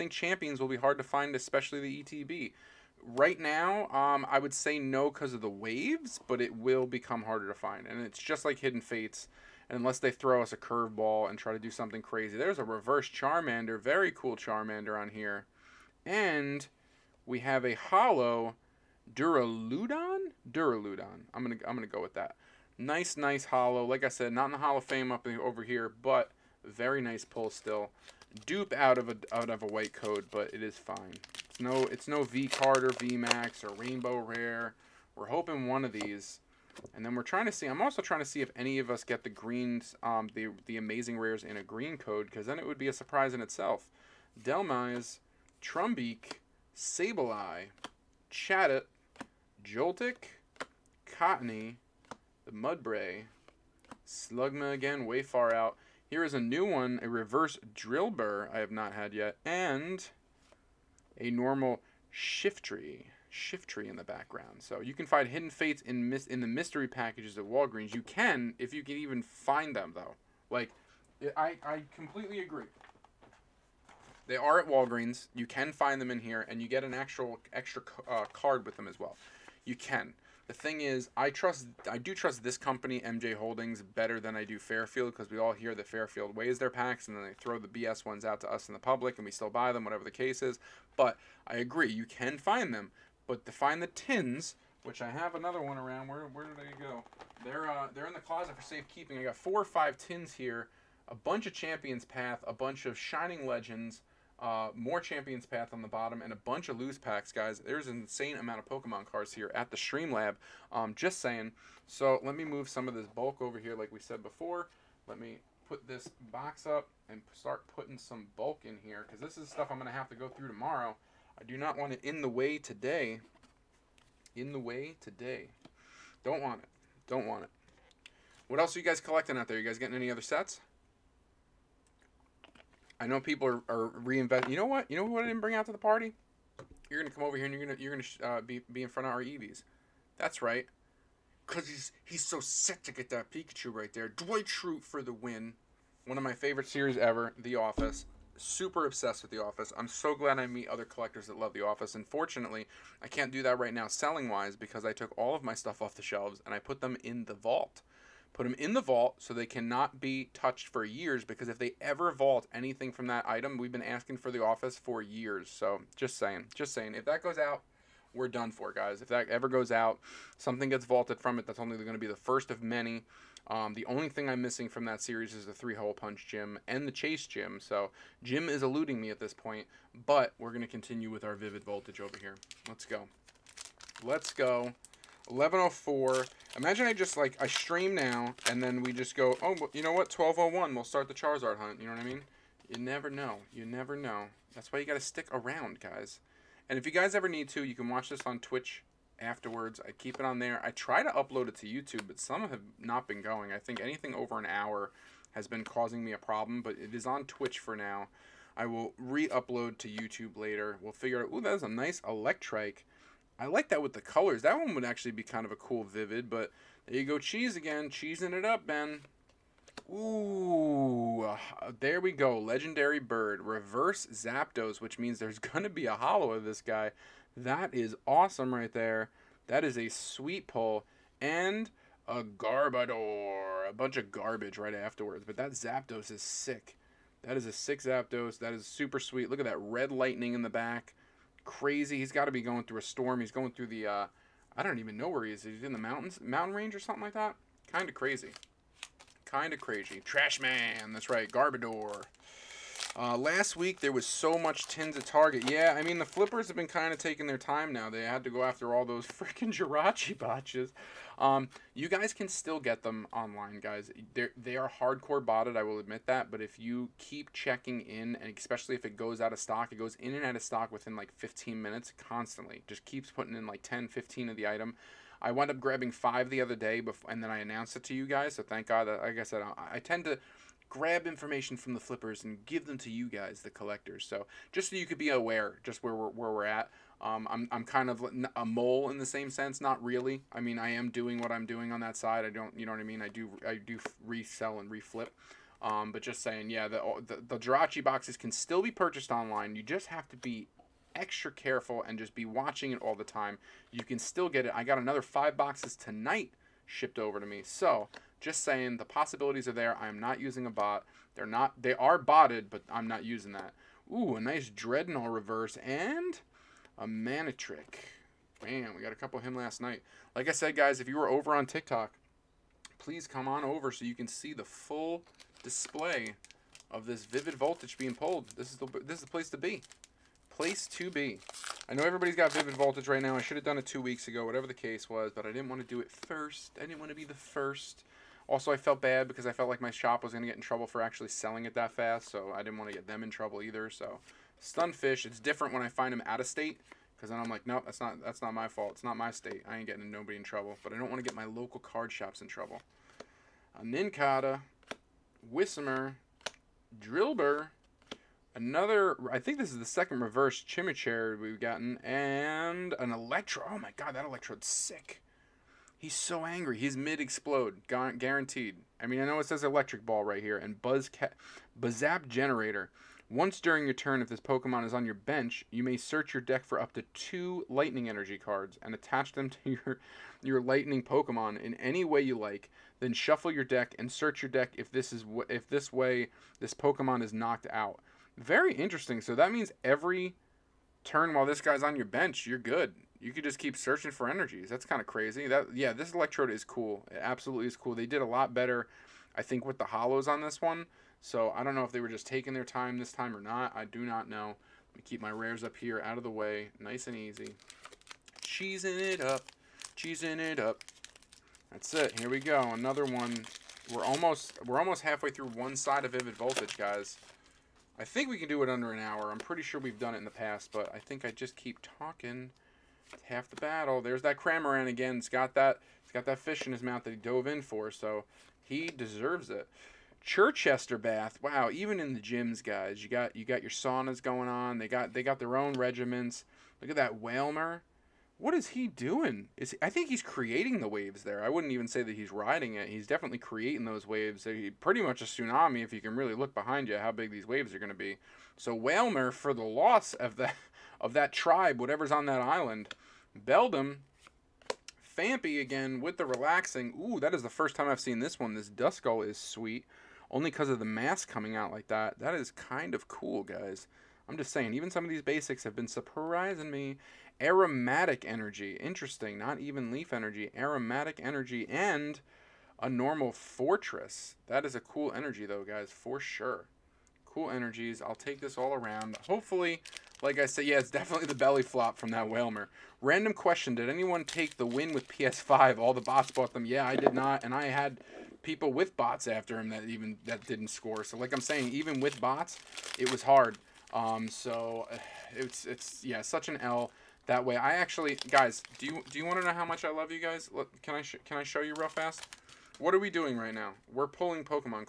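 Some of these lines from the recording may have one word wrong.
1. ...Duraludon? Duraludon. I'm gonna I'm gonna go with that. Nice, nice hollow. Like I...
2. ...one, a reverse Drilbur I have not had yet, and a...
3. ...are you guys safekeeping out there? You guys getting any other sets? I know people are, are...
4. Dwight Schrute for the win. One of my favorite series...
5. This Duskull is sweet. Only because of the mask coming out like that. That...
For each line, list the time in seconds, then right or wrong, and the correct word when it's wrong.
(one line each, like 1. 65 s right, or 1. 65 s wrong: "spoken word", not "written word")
1. 19 s right
2. 56 s right
3. 128 s wrong: "collecting", not "safekeeping"
4. 144 s right
5. 458 s right.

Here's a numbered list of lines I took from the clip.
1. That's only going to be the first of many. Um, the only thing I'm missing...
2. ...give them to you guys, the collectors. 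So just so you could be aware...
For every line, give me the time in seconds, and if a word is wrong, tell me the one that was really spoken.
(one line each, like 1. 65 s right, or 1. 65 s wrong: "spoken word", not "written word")
1. 171 s right
2. 282 s right.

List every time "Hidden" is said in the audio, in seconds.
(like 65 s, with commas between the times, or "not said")
8 s, 65 s.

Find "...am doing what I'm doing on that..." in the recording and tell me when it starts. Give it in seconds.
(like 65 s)
290 s.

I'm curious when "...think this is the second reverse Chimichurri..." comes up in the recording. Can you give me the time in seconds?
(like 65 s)
359 s.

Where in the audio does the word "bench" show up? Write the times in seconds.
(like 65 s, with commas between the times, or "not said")
374 s, 391 s.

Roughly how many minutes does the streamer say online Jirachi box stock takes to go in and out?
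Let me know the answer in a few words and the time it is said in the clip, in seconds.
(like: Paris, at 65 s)
15, at 271 s.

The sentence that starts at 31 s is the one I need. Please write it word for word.
It's no it's no V card or V Max or Rainbow Rare.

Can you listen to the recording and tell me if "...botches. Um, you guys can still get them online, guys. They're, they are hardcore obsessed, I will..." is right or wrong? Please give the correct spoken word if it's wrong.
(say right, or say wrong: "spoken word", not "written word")
wrong: "botted", not "obsessed".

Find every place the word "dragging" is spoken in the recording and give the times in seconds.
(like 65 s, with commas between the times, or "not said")
not said.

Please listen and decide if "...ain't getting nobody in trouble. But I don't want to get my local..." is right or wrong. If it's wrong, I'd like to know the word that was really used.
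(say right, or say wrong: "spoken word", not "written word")
right.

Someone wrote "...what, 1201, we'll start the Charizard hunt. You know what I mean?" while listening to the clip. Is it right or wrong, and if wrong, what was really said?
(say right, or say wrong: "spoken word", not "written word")
right.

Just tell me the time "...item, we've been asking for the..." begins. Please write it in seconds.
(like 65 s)
163 s.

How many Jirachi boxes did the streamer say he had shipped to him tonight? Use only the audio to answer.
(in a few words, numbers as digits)
5.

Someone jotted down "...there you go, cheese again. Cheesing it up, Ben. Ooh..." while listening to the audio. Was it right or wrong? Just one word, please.
right.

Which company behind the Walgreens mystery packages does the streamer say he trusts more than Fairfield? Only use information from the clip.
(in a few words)
MJ Holdings.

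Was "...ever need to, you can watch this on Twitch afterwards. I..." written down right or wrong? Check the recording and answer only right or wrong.
right.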